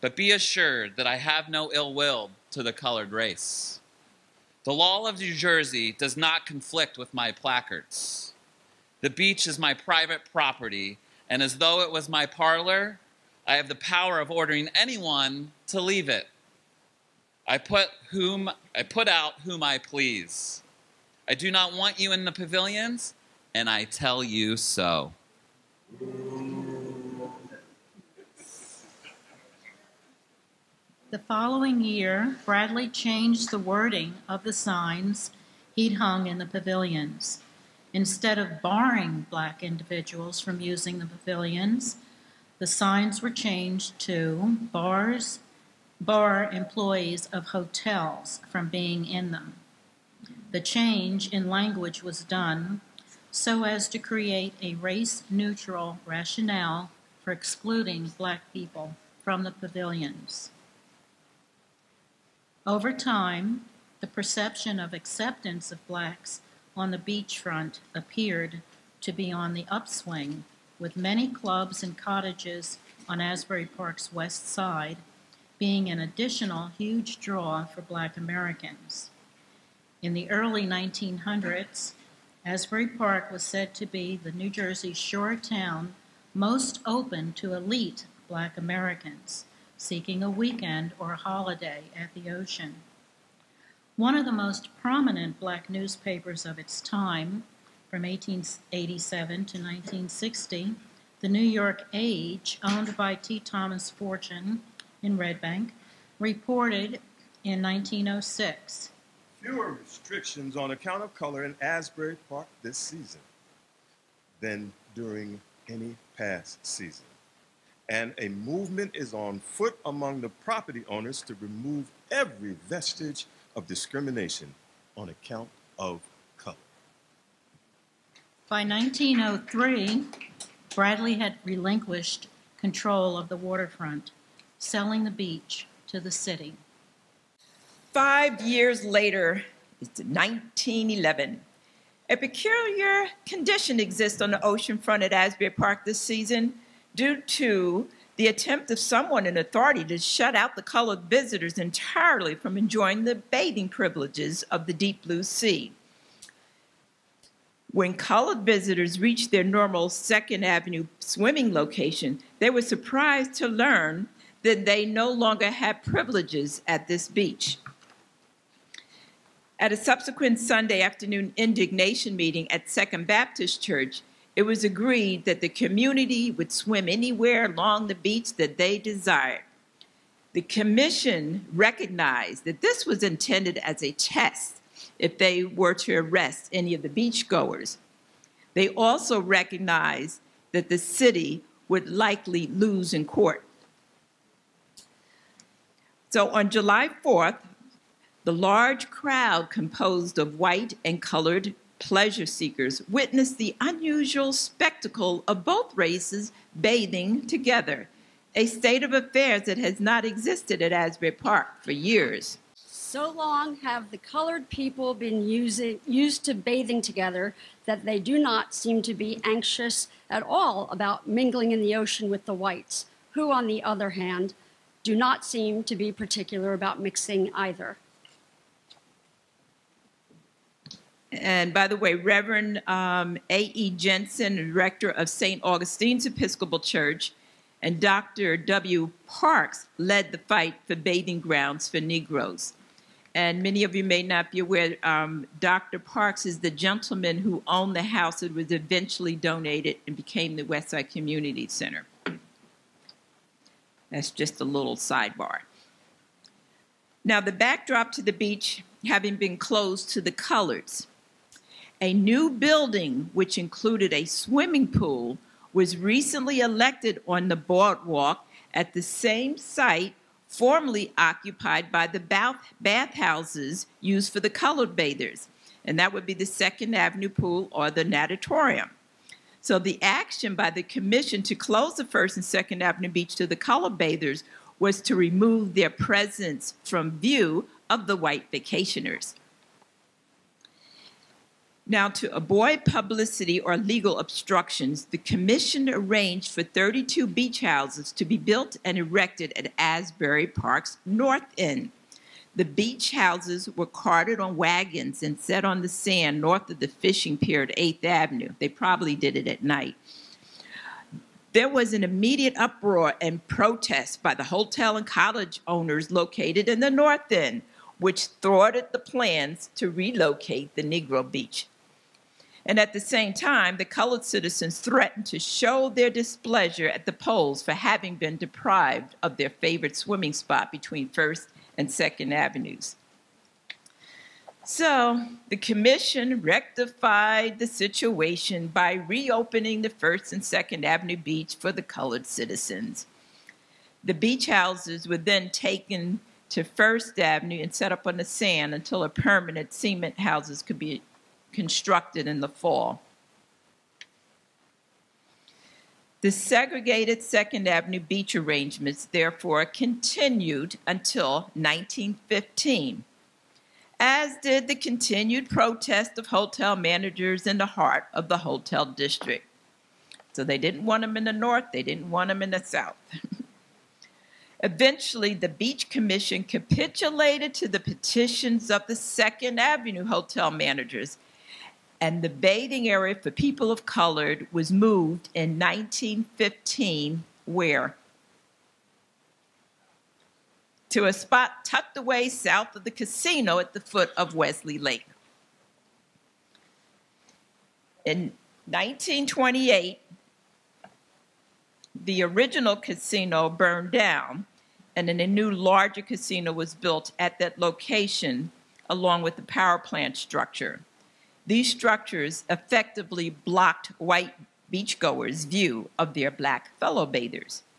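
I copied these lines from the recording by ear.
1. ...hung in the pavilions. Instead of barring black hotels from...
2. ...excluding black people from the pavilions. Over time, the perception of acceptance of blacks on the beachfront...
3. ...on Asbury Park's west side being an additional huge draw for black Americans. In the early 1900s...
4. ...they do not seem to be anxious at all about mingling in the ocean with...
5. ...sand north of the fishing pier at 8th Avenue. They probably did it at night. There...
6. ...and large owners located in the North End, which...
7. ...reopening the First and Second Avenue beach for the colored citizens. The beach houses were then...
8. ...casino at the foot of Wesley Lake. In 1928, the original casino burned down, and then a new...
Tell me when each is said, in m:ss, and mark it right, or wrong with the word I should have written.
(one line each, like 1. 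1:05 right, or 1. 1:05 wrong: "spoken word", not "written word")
1. 0:35 wrong: "individuals", not "hotels"
2. 0:57 right
3. 1:13 right
4. 3:37 right
5. 5:05 right
6. 5:14 wrong: "college", not "large"
7. 5:38 right
8. 6:32 right.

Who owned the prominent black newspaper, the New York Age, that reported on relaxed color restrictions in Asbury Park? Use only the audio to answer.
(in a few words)
T. Thomas Fortune.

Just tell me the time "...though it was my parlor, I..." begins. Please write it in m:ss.
0:11.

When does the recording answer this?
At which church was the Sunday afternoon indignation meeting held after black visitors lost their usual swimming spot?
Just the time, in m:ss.
2:52.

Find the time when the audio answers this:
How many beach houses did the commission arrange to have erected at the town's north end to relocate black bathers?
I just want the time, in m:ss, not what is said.
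4:56.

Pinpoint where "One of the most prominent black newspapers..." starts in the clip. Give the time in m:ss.
1:33.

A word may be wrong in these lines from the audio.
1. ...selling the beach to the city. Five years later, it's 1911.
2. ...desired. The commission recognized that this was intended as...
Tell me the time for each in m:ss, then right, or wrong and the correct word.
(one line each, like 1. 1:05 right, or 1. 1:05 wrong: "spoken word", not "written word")
1. 2:14 right
2. 2:58 right.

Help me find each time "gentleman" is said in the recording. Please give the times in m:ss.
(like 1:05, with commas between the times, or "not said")
4:06.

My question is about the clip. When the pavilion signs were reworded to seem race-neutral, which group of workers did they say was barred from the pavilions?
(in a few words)
Employees of hotels.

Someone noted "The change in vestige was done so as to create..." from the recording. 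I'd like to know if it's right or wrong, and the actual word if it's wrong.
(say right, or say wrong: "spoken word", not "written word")
wrong: "language", not "vestige".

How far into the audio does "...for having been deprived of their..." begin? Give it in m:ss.
5:27.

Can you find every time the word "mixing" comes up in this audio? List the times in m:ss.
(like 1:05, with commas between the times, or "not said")
3:46.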